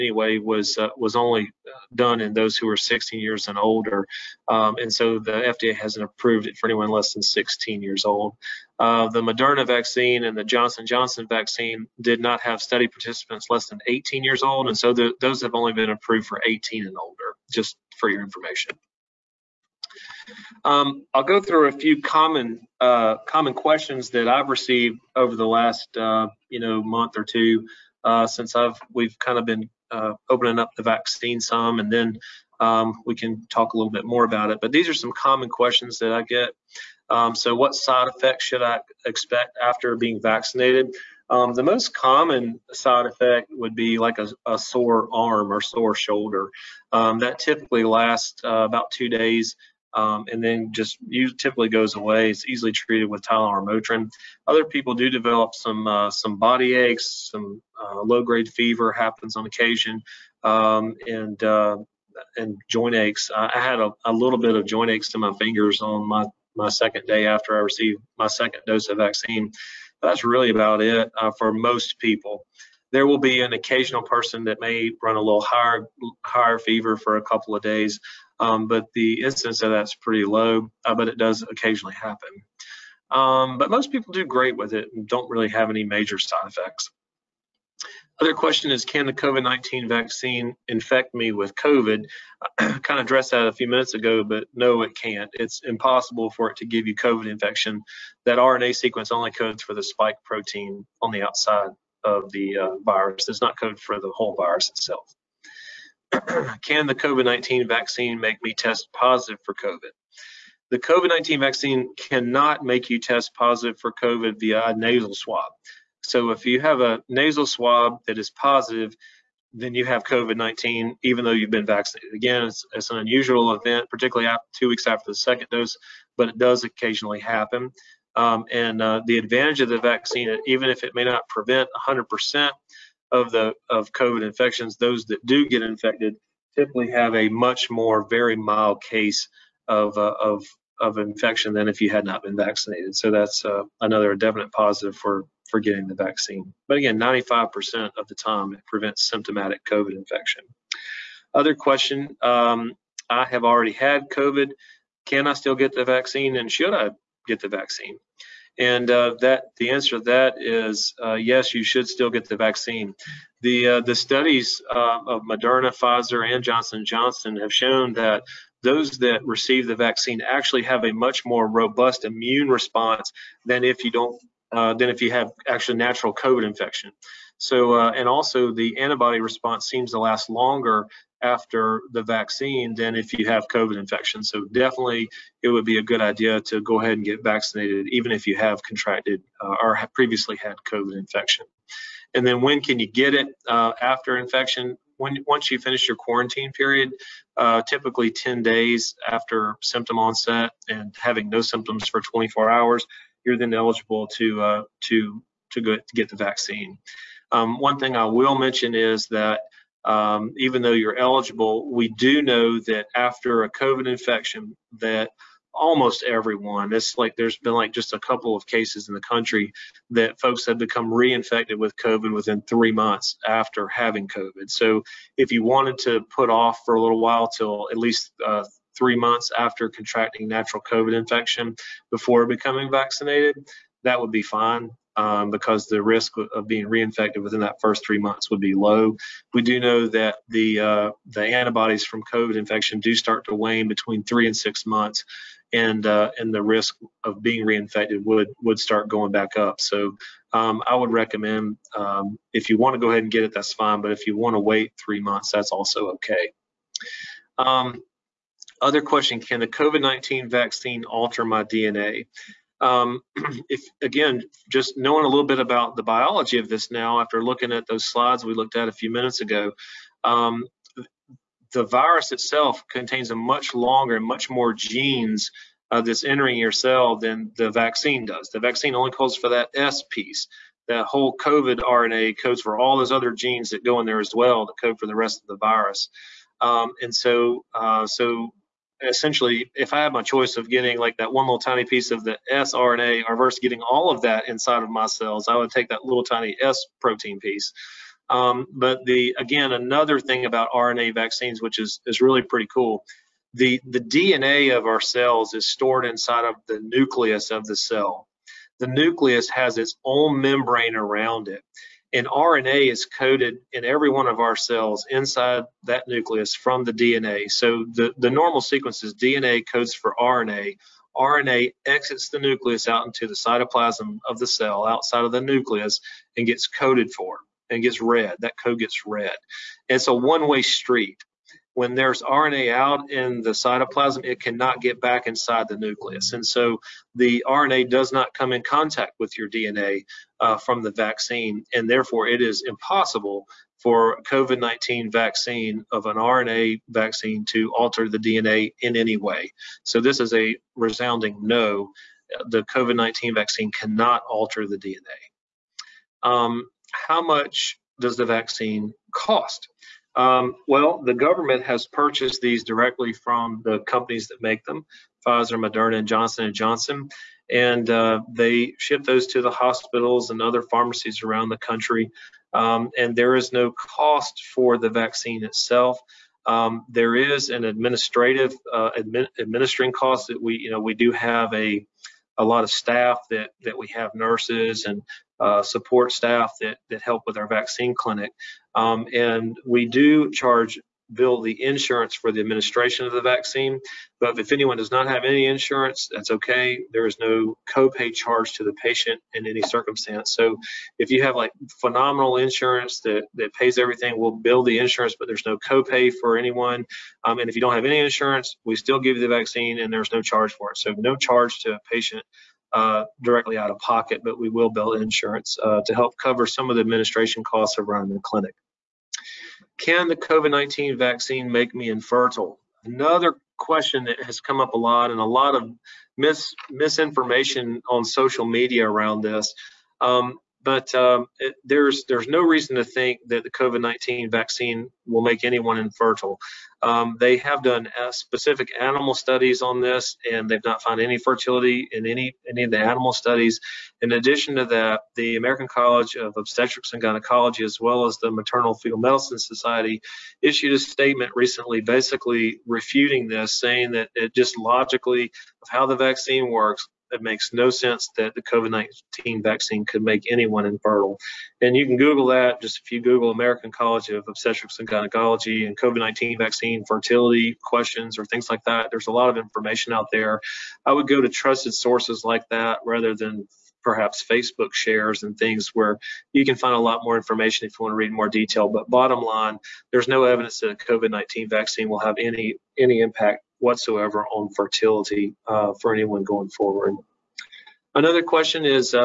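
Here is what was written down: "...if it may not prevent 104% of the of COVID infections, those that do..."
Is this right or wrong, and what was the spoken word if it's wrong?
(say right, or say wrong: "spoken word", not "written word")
wrong: "100", not "104".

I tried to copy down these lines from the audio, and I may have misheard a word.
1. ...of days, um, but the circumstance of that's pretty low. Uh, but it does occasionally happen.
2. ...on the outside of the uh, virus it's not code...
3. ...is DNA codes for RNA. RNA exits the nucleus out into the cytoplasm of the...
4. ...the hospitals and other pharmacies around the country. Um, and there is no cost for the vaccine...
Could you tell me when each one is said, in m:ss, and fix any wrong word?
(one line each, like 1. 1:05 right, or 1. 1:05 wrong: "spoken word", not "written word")
1. 1:17 wrong: "incidence", not "circumstance"
2. 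1:41 right
3. 5:18 right
4. 6:09 right.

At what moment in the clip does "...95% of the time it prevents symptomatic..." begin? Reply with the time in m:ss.
2:26.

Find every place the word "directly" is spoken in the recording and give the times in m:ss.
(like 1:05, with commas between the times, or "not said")
6:02, 6:53.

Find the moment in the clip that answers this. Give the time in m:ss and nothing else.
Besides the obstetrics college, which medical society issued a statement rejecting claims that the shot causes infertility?
7:28.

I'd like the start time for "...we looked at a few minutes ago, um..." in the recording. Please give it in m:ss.
4:28.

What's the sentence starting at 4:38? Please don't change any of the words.
The vaccine only codes for that S piece.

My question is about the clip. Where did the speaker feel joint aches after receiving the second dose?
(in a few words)
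fingers.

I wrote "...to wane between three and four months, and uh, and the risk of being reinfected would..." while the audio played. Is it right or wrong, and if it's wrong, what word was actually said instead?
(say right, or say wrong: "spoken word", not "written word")
wrong: "six", not "four".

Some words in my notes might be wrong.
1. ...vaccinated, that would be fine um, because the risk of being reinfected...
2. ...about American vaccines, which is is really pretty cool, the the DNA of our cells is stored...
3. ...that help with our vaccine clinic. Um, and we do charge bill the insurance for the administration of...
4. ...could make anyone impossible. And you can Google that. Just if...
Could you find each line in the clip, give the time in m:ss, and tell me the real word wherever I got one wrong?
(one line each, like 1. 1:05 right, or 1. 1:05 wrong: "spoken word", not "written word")
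1. 3:52 right
2. 5:00 wrong: "RNA", not "American"
3. 6:26 right
4. 7:39 wrong: "infertile", not "impossible".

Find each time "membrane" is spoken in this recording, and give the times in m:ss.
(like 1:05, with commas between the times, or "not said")
5:10.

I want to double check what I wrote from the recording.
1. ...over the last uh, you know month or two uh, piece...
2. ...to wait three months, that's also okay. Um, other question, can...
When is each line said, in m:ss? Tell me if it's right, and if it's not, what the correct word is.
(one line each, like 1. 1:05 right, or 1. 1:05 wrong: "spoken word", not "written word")
1. 0:25 wrong: "since", not "piece"
2. 4:14 right.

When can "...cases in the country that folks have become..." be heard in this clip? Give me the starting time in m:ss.
3:38.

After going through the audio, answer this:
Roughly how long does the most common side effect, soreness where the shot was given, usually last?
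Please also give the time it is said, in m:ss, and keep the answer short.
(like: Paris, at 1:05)
about 2 days, at 0:48.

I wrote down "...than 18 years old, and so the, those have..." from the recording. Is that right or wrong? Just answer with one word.
right.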